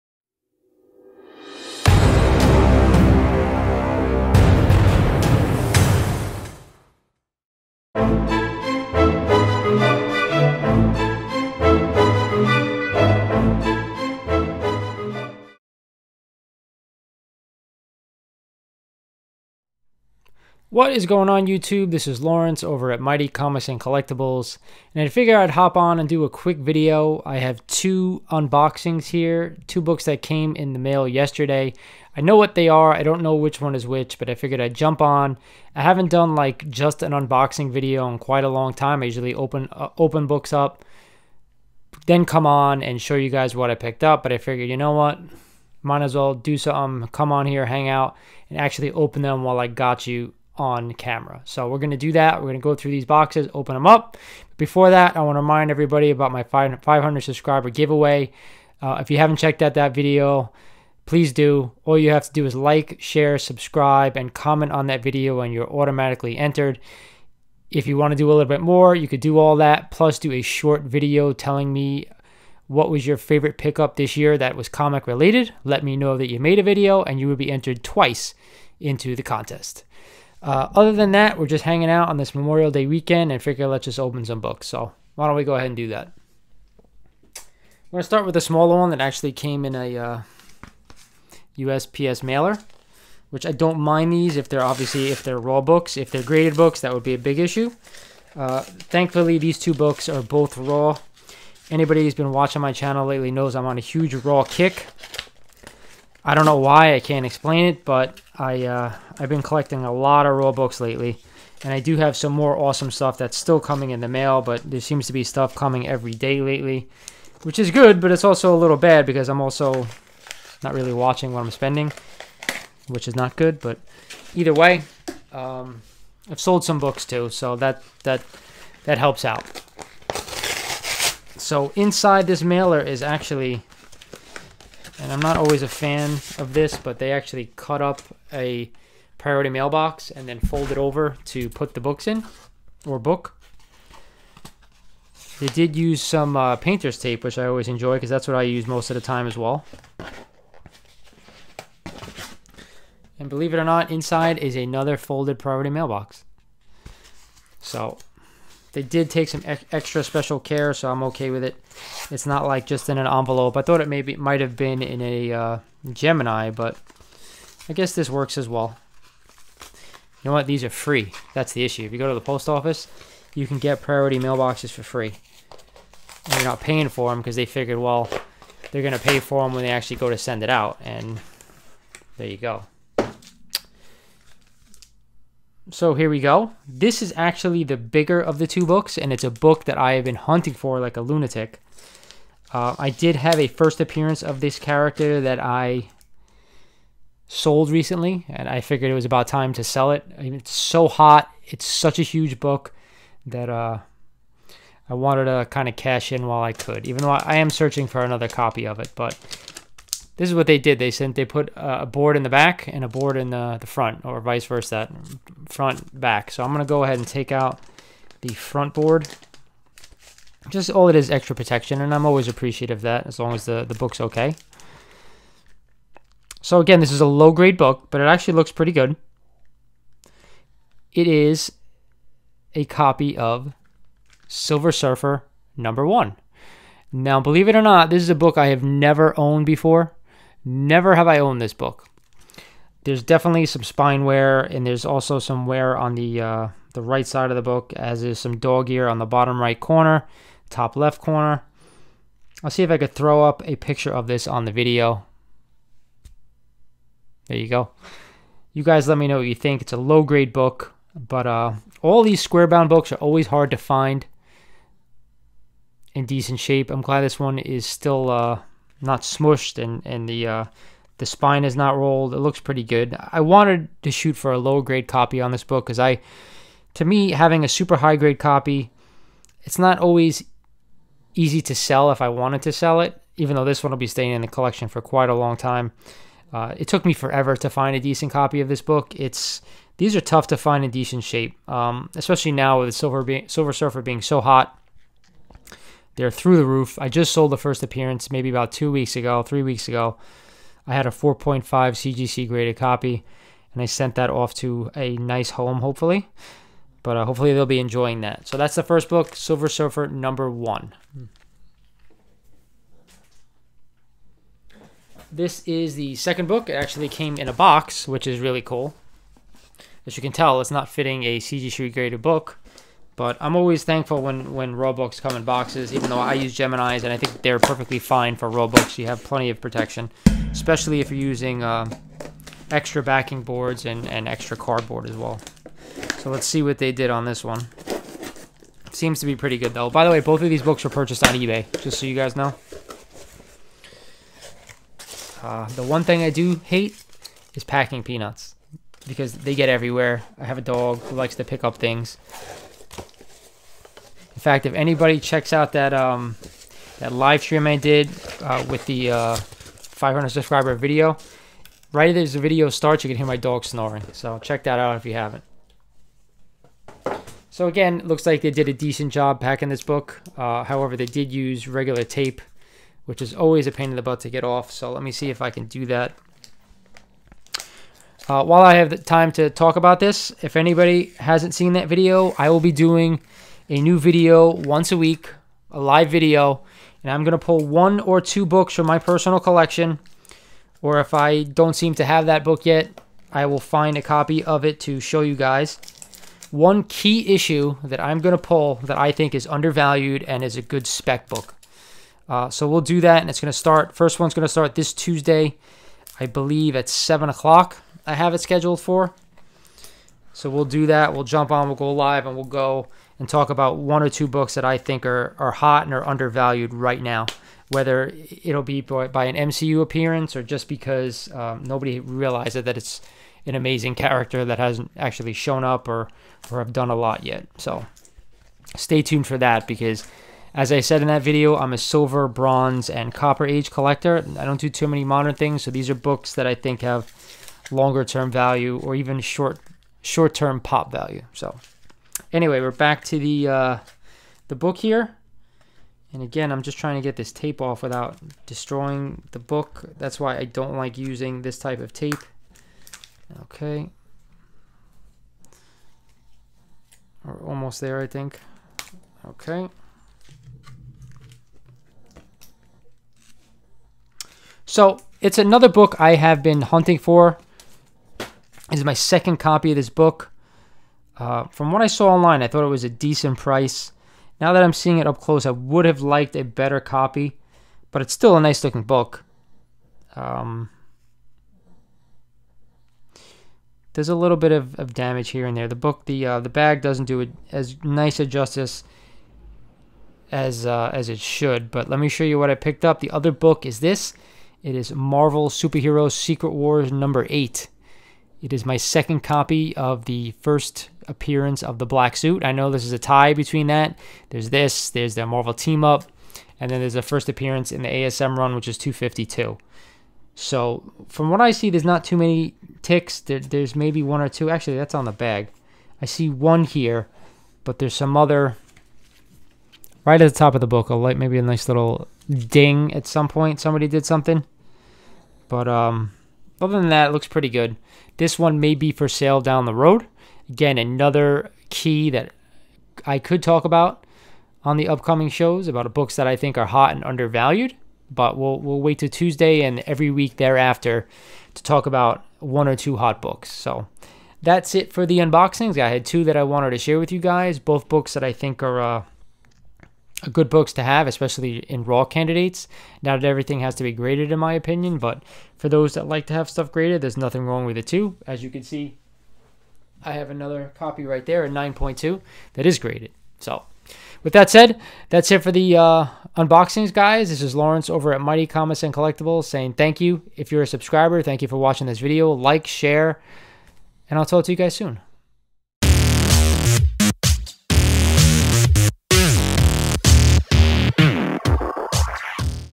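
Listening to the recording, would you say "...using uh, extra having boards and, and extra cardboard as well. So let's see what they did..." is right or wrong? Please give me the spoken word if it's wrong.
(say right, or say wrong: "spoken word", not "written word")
wrong: "backing", not "having".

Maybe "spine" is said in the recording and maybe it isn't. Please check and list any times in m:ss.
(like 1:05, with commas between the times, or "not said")
4:03, 4:31.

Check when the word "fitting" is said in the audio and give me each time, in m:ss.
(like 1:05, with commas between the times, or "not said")
5:20.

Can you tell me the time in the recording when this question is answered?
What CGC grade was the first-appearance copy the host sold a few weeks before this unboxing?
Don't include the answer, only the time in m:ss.
5:00.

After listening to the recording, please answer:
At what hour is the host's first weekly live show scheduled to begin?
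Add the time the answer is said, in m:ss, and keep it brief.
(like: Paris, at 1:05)
7 o'clock, at 6:46.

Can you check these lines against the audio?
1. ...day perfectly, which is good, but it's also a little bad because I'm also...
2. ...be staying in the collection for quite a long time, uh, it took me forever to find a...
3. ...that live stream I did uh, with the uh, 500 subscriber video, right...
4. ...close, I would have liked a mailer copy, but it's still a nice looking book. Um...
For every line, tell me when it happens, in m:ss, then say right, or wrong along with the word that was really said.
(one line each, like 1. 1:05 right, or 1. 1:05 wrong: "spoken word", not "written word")
1. 1:56 wrong: "lately", not "perfectly"
2. 4:43 right
3. 5:56 right
4. 7:54 wrong: "better", not "mailer".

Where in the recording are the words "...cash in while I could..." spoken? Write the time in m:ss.
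3:25.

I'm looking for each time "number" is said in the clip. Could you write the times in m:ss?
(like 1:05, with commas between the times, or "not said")
3:55, 5:09, 8:16.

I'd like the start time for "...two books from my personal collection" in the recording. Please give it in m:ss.
6:27.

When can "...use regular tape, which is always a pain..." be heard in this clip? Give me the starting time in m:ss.
6:11.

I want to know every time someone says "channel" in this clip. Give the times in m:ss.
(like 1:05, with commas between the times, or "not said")
1:42.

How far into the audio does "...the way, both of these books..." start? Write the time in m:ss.
5:39.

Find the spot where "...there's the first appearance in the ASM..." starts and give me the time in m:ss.
8:26.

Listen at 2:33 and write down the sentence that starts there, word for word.
And believe it or not, inside is another folded priority mailbox.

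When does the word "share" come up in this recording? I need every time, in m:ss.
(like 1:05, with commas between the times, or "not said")
1:03, 9:06, 9:32.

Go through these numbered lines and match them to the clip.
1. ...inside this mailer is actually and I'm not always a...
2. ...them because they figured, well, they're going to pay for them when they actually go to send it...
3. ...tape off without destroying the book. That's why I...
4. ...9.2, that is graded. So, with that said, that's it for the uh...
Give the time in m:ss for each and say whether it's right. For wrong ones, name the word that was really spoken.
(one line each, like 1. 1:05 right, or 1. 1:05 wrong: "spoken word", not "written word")
1. 2:11 right
2. 2:57 right
3. 7:27 right
4. 9:21 right.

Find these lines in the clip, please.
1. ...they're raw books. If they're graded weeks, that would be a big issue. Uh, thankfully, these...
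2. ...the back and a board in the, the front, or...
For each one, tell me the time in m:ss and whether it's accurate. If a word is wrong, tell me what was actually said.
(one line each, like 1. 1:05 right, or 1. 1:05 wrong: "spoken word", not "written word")
1. 1:35 wrong: "books", not "weeks"
2. 3:32 right.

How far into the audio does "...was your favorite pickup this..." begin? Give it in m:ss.
1:12.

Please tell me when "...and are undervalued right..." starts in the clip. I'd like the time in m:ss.
6:55.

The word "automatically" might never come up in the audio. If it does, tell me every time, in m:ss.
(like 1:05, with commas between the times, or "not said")
1:05.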